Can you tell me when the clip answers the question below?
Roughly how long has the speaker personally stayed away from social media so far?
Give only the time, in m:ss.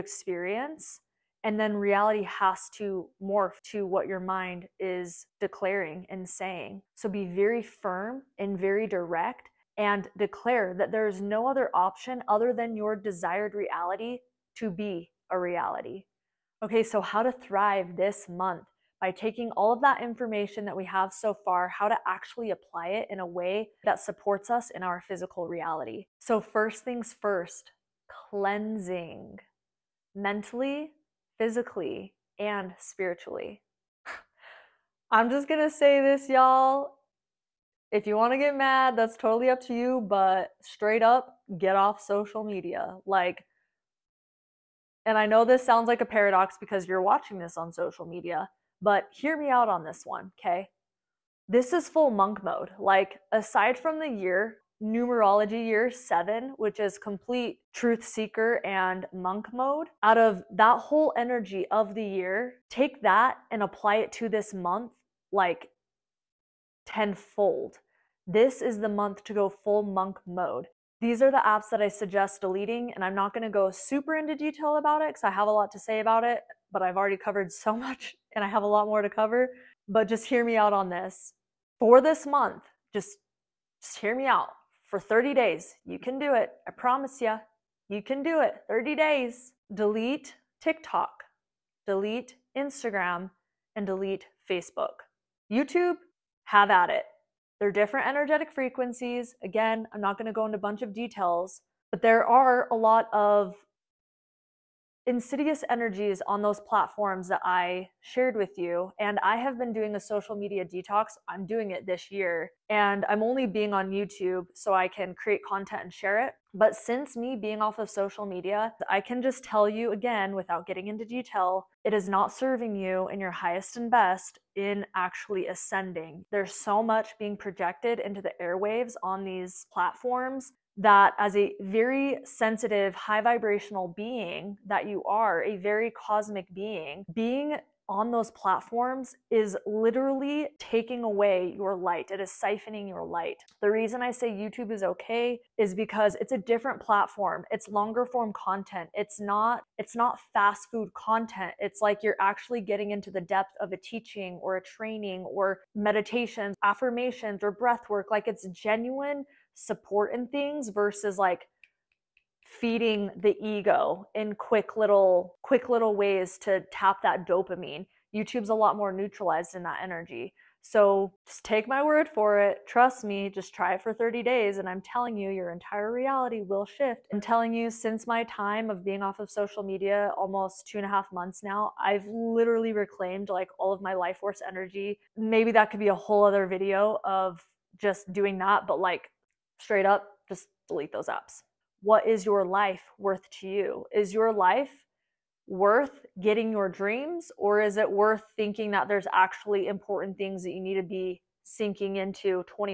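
3:00.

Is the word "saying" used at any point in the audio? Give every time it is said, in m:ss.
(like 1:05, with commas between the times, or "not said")
0:06.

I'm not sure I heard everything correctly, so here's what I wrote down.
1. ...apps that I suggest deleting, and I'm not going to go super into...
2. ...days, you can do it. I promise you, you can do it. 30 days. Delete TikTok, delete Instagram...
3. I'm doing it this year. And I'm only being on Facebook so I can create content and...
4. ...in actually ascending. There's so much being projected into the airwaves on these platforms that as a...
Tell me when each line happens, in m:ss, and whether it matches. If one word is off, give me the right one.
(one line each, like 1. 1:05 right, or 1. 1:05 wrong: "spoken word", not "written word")
1. 1:11 right
2. 1:25 right
3. 1:51 wrong: "YouTube", not "Facebook"
4. 2:04 right.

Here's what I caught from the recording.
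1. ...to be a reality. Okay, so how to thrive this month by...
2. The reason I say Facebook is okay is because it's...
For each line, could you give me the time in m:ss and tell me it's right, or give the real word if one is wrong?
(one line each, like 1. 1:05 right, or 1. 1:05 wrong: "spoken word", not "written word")
1. 0:14 right
2. 2:23 wrong: "YouTube", not "Facebook".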